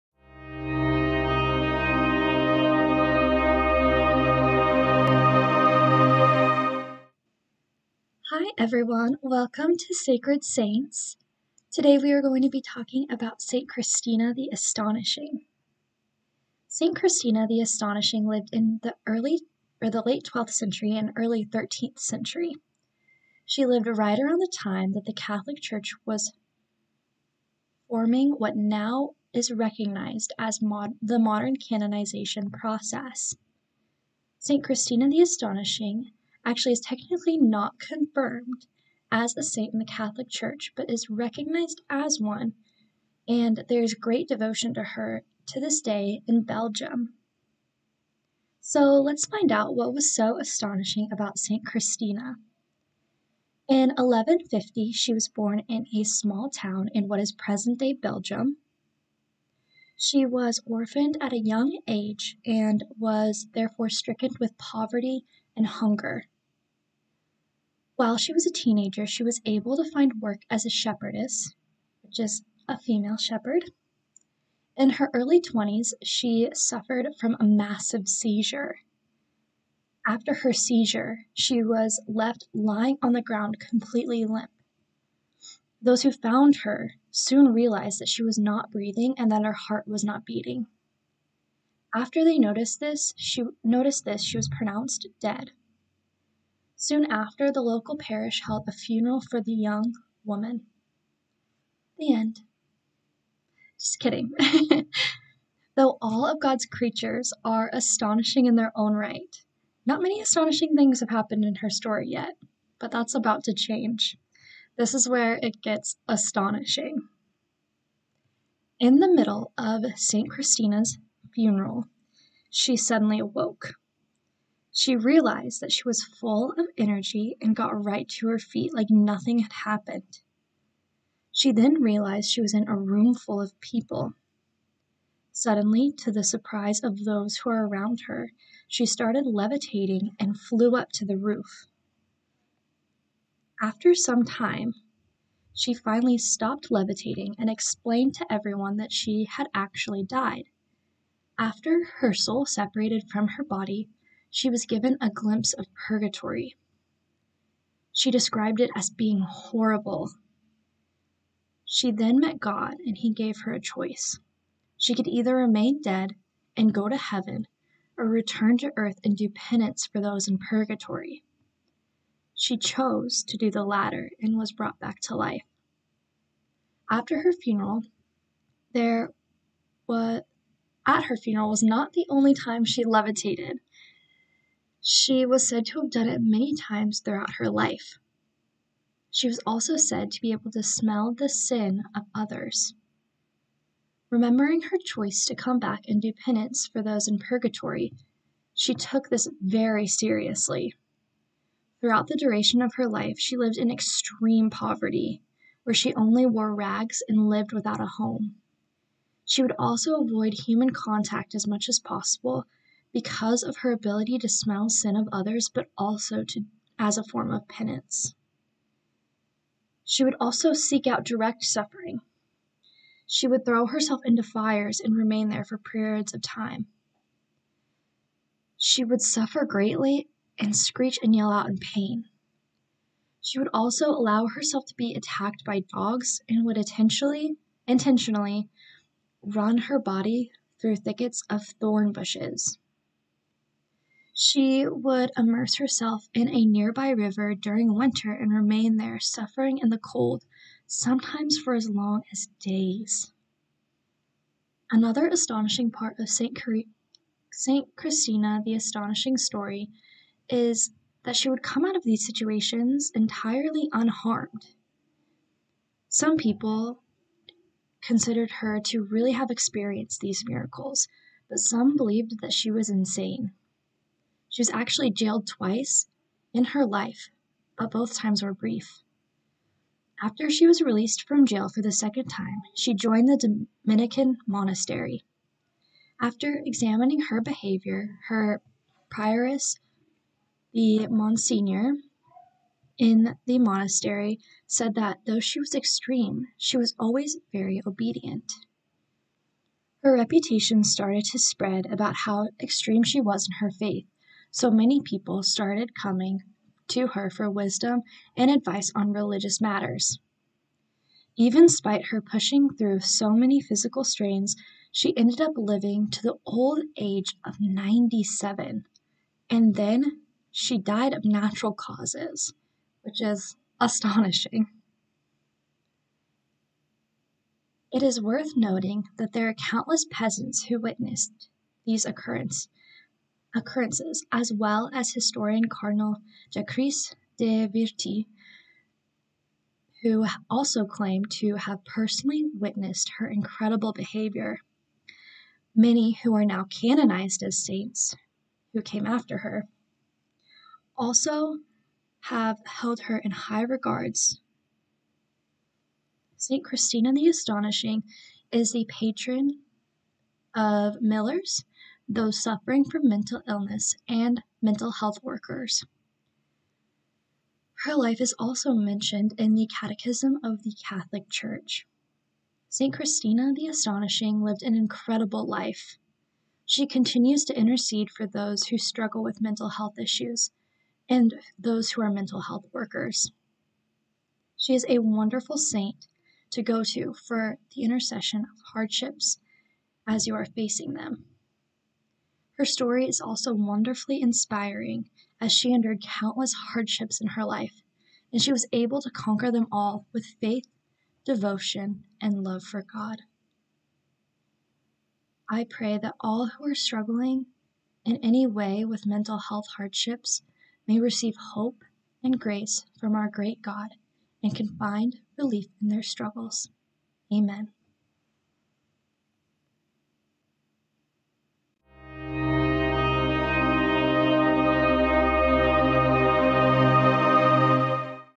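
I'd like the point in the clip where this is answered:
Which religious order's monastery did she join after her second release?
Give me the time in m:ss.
4:43.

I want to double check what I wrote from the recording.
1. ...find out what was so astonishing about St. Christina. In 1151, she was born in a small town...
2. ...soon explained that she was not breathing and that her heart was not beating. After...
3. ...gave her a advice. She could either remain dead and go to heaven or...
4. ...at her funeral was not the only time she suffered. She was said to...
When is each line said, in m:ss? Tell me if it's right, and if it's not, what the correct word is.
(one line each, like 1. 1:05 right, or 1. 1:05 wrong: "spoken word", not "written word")
1. 0:49 wrong: "1150", not "1151"
2. 1:27 wrong: "realized", not "explained"
3. 2:43 wrong: "choice", not "advice"
4. 3:00 wrong: "levitated", not "suffered".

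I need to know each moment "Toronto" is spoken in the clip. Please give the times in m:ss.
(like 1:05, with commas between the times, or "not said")
not said.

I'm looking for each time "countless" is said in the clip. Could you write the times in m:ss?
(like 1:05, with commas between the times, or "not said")
5:29, 6:35.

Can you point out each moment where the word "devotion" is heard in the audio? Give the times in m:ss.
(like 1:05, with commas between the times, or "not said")
0:44, 6:41.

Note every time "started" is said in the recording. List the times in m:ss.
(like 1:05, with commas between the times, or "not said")
2:18, 5:00, 5:05.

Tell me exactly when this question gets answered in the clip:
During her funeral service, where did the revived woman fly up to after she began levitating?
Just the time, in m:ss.
2:21.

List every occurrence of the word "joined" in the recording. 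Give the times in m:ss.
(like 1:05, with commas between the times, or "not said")
4:42.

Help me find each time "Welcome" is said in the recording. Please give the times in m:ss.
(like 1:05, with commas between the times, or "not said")
0:09.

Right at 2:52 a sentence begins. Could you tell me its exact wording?
She chose to do the latter and was brought back to life.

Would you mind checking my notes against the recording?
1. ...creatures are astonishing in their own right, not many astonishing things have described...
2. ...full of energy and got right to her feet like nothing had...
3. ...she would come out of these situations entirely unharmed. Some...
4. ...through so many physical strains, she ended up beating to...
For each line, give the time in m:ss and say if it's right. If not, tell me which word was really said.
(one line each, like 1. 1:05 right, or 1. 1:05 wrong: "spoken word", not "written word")
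1. 1:46 wrong: "happened", not "described"
2. 2:06 right
3. 4:21 right
4. 5:12 wrong: "living", not "beating".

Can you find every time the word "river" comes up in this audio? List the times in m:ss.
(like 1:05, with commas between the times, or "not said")
4:06.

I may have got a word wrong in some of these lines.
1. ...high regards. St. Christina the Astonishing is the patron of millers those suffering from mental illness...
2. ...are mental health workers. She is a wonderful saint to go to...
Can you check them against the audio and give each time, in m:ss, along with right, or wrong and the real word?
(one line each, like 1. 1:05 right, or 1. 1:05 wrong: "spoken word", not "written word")
1. 5:53 right
2. 6:21 right.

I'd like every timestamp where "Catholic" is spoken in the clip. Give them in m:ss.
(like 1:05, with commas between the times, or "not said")
0:25, 0:39, 6:10.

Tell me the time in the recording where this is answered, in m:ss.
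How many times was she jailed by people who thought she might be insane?
4:35.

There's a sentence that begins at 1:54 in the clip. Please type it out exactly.
This is where it gets astonishing.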